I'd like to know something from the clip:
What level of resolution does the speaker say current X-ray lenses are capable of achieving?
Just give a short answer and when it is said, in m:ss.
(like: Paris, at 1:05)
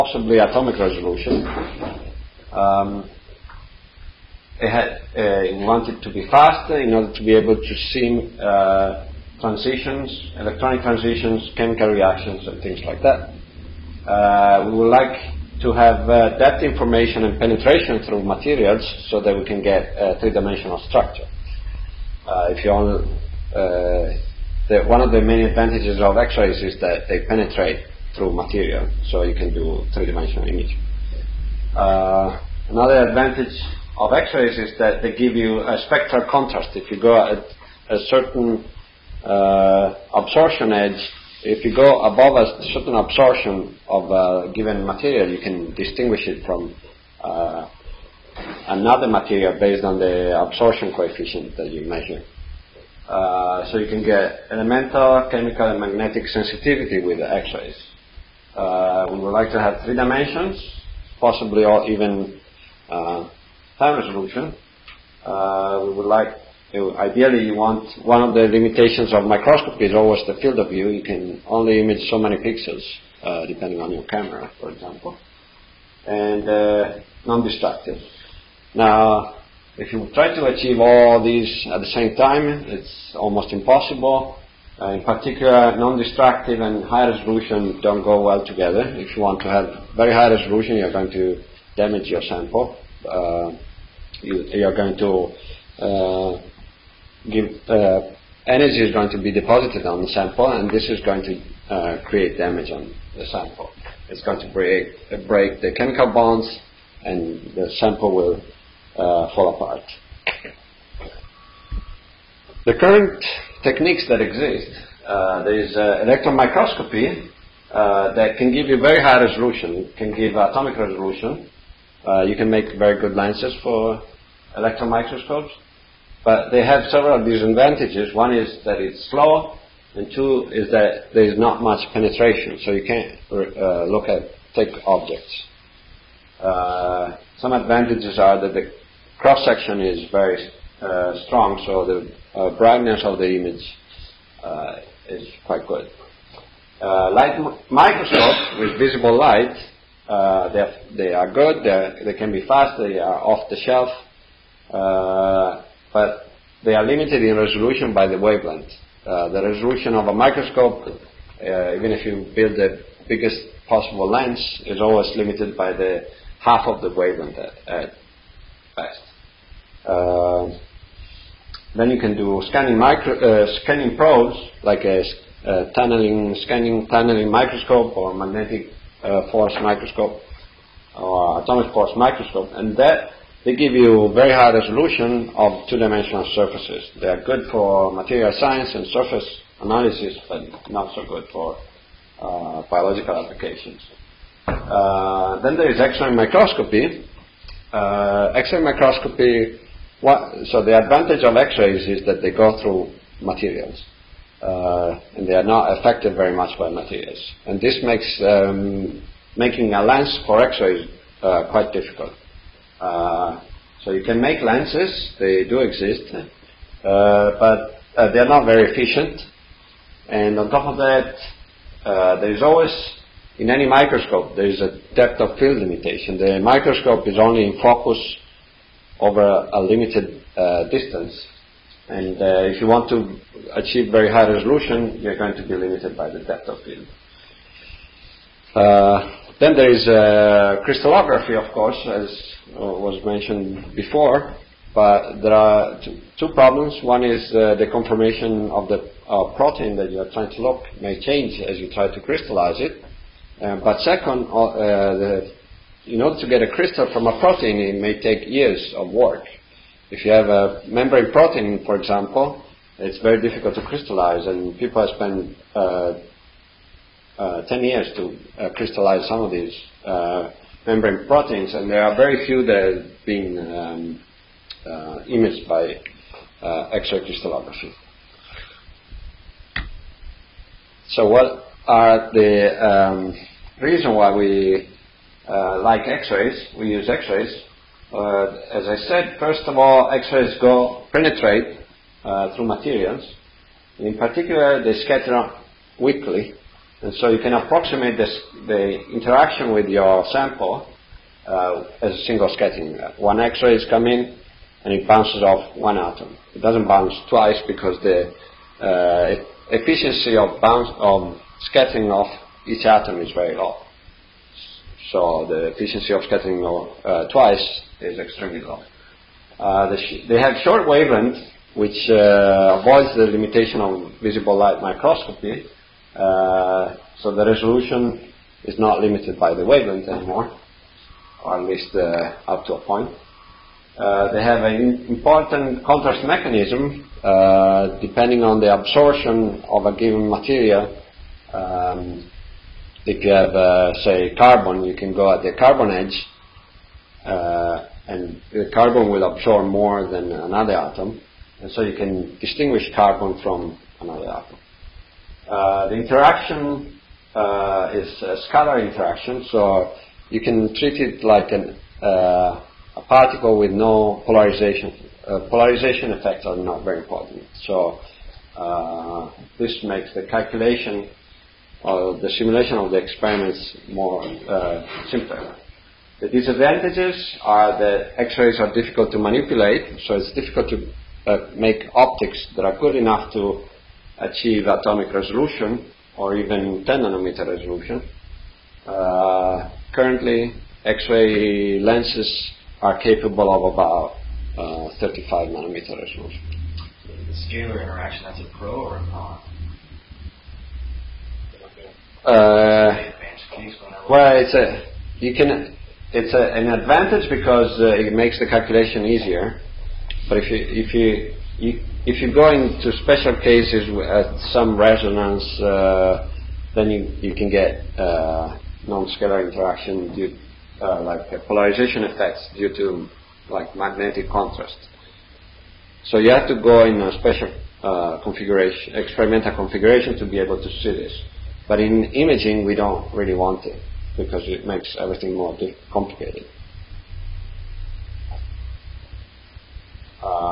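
35 nanometers, at 6:34.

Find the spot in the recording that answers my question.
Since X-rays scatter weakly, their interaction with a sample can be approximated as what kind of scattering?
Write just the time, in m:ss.
5:02.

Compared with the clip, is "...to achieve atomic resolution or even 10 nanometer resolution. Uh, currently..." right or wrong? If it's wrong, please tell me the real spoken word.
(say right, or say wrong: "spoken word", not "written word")
right.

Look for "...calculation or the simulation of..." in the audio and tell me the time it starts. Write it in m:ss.
6:10.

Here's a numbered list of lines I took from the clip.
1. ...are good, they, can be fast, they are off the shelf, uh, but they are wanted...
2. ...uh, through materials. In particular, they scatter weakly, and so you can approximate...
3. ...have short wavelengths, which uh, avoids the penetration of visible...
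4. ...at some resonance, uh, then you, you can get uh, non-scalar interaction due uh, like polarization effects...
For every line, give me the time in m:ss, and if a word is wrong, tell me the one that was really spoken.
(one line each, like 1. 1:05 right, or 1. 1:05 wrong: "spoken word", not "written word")
1. 2:31 wrong: "limited", not "wanted"
2. 4:52 right
3. 5:20 wrong: "limitation", not "penetration"
4. 6:53 right.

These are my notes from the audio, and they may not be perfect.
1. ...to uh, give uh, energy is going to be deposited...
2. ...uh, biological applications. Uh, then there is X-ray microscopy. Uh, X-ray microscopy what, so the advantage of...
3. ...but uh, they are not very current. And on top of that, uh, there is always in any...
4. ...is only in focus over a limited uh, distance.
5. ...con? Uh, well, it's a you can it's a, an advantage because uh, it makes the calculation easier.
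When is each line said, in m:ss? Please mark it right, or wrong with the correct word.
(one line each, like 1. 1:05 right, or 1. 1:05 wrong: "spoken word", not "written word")
1. 1:34 right
2. 3:12 right
3. 3:36 wrong: "efficient", not "current"
4. 3:47 right
5. 6:38 right.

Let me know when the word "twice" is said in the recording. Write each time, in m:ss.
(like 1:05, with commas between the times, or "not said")
5:07, 5:17.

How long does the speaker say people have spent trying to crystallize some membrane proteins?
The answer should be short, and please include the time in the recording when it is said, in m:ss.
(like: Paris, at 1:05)
10 years, at 4:27.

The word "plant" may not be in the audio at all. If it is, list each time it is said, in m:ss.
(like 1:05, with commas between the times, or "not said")
not said.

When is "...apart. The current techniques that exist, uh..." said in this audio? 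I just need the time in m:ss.
1:49.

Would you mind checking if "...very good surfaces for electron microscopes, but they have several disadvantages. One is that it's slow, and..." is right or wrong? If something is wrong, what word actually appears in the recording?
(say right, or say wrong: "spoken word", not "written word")
wrong: "lenses", not "surfaces".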